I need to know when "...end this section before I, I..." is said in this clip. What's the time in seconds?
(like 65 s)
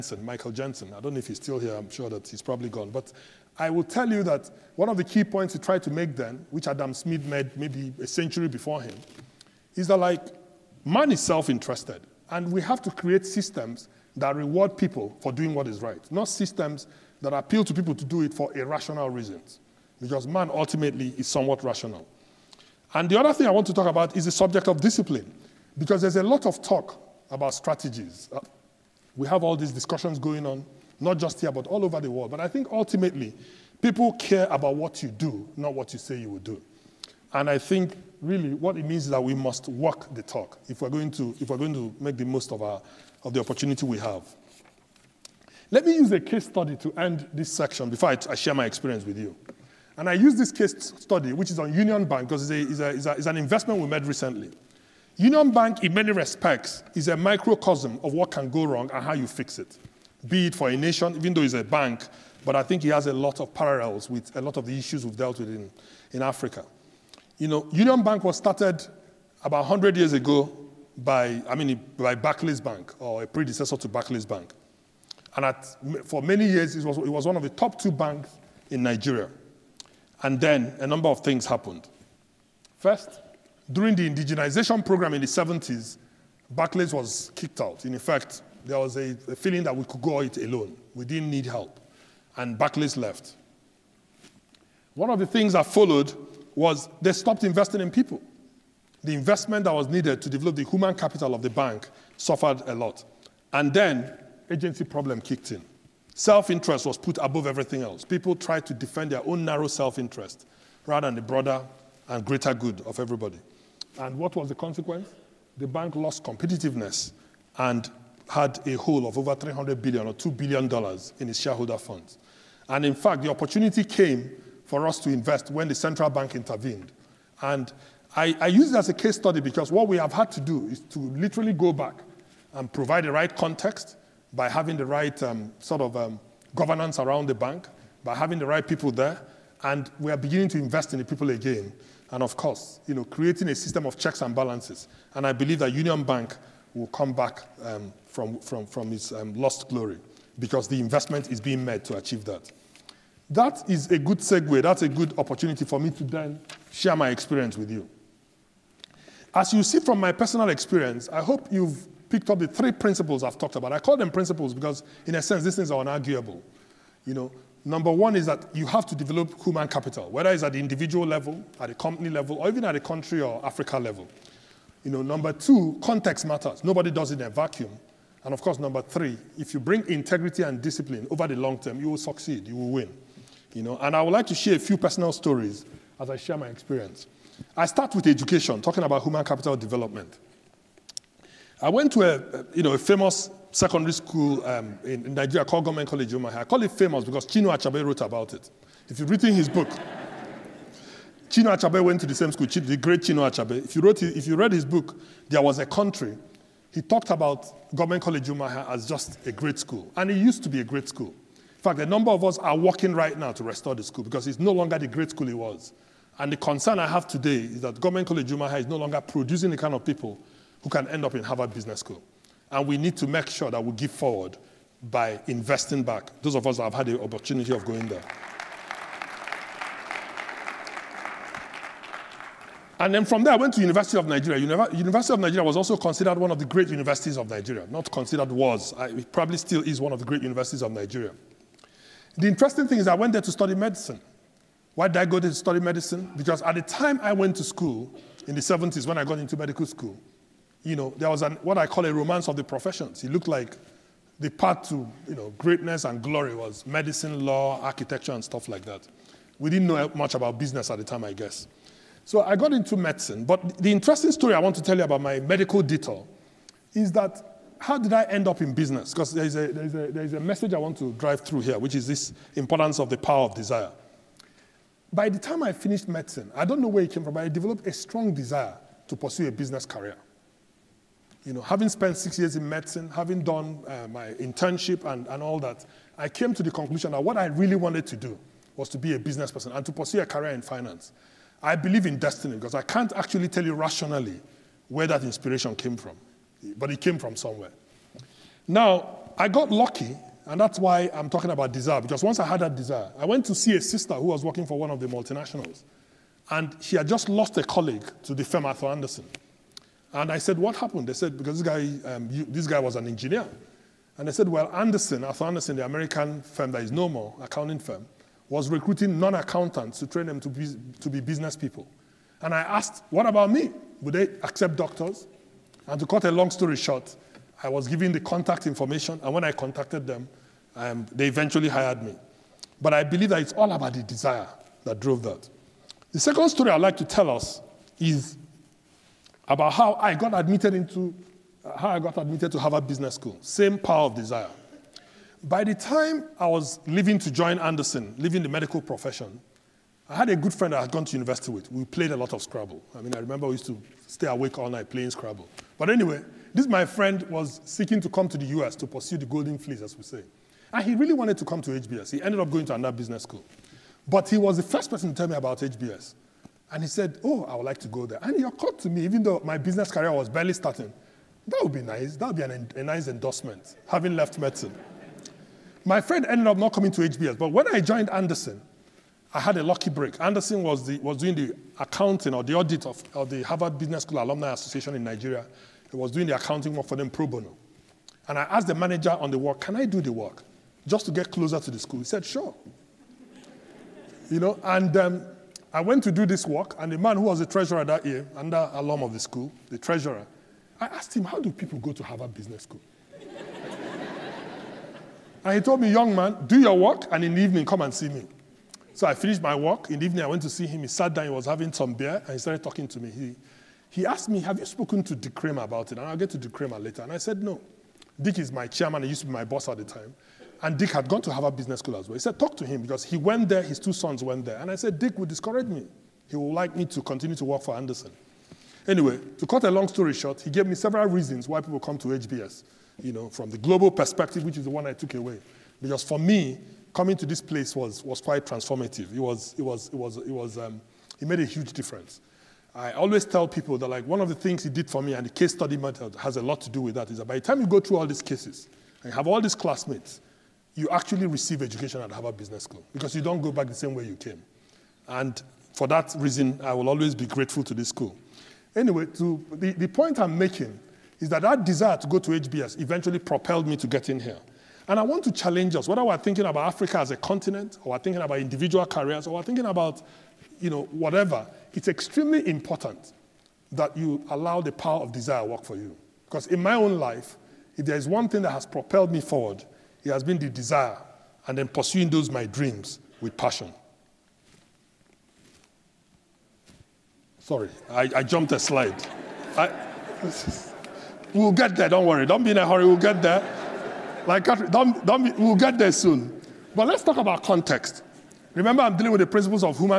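46 s.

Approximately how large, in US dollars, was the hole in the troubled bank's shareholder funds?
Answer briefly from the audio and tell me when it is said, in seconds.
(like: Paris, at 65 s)
2 billion dollars, at 120 s.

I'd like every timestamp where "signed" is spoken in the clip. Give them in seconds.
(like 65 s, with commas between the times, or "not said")
not said.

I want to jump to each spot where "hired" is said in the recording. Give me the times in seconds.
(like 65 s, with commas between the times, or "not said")
331 s.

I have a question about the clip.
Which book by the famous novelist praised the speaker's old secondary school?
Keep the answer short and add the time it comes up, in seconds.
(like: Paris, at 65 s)
There Was a Country, at 205 s.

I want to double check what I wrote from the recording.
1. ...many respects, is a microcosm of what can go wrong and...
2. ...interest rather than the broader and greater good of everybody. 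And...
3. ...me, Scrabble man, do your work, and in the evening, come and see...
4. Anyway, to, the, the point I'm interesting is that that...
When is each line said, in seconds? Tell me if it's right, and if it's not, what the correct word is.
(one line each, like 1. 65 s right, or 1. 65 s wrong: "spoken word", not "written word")
1. 55 s right
2. 109 s right
3. 405 s wrong: "Young", not "Scrabble"
4. 458 s wrong: "making", not "interesting".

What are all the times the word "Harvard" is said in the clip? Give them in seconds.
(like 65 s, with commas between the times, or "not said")
221 s, 342 s, 383 s, 401 s, 421 s, 451 s.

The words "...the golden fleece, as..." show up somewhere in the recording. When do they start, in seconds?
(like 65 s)
358 s.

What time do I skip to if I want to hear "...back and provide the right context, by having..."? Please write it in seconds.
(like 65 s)
131 s.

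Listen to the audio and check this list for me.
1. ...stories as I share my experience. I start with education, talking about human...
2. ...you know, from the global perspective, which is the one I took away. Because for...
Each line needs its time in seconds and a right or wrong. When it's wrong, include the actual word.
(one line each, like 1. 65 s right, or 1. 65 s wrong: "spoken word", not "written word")
1. 185 s right
2. 432 s right.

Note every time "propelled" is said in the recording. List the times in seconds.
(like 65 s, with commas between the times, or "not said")
462 s, 478 s.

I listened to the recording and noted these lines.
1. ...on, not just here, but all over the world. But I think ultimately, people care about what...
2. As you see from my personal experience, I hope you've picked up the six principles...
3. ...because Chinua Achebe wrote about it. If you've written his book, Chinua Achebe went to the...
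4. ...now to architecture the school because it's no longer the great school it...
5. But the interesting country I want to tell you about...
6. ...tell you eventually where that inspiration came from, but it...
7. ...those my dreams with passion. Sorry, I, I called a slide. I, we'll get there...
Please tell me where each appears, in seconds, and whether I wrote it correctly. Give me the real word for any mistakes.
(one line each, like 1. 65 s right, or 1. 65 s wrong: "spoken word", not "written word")
1. 30 s right
2. 159 s wrong: "three", not "six"
3. 197 s right
4. 213 s wrong: "restore", not "architecture"
5. 263 s wrong: "story", not "country"
6. 293 s wrong: "rationally", not "eventually"
7. 481 s wrong: "jumped", not "called".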